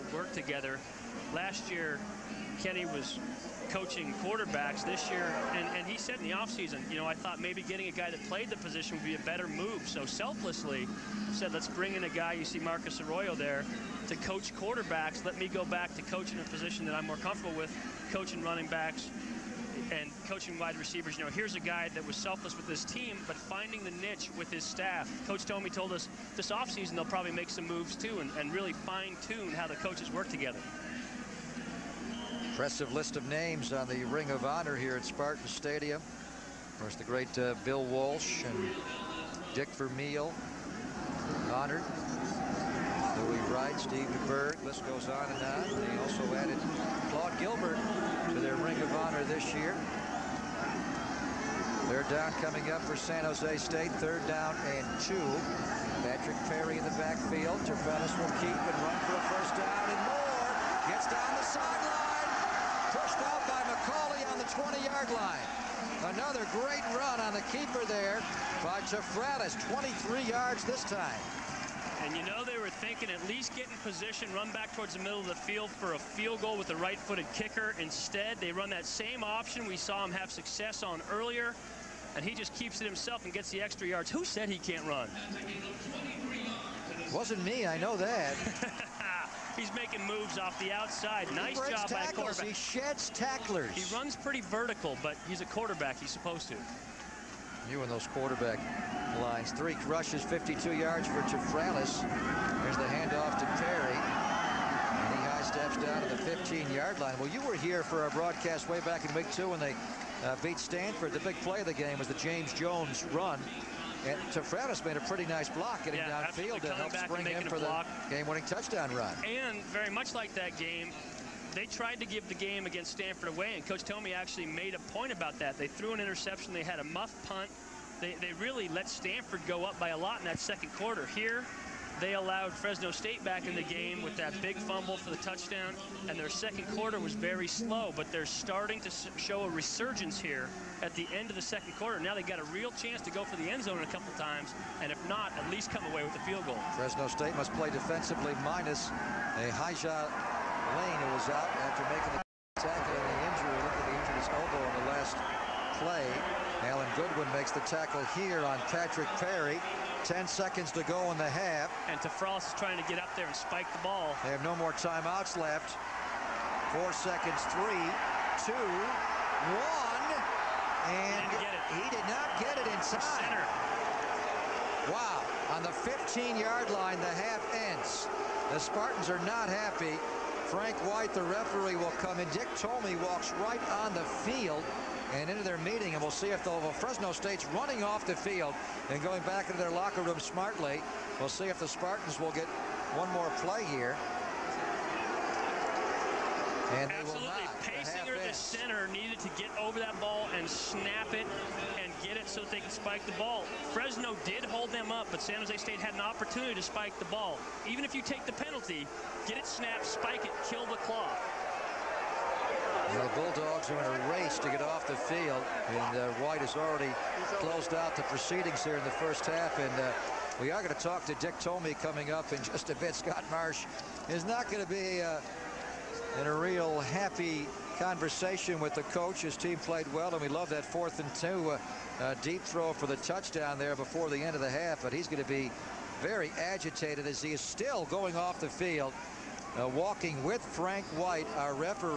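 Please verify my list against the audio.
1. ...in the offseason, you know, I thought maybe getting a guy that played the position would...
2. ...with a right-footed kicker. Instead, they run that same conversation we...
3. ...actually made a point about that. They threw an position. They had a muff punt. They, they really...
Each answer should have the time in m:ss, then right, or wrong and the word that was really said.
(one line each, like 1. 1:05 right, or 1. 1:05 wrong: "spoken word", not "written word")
1. 0:06 right
2. 1:16 wrong: "option", not "conversation"
3. 2:04 wrong: "interception", not "position".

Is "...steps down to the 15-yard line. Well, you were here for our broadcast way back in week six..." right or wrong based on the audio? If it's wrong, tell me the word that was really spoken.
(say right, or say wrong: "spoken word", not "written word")
wrong: "two", not "six".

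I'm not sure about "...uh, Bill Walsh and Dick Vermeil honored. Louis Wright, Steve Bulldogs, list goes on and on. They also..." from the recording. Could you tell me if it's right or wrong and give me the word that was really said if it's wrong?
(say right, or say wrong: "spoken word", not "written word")
wrong: "DeBerg", not "Bulldogs".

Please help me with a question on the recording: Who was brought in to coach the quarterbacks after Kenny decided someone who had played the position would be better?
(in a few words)
Marcus Arroyo.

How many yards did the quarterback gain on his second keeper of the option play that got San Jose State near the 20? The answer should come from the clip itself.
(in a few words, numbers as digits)
23.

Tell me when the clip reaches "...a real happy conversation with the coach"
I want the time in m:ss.
3:46.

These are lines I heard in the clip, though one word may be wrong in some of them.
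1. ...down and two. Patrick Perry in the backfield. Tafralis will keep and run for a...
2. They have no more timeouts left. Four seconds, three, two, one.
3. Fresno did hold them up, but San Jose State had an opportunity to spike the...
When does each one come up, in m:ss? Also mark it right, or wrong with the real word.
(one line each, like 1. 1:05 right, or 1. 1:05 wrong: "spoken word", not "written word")
1. 0:54 right
2. 2:44 right
3. 3:23 right.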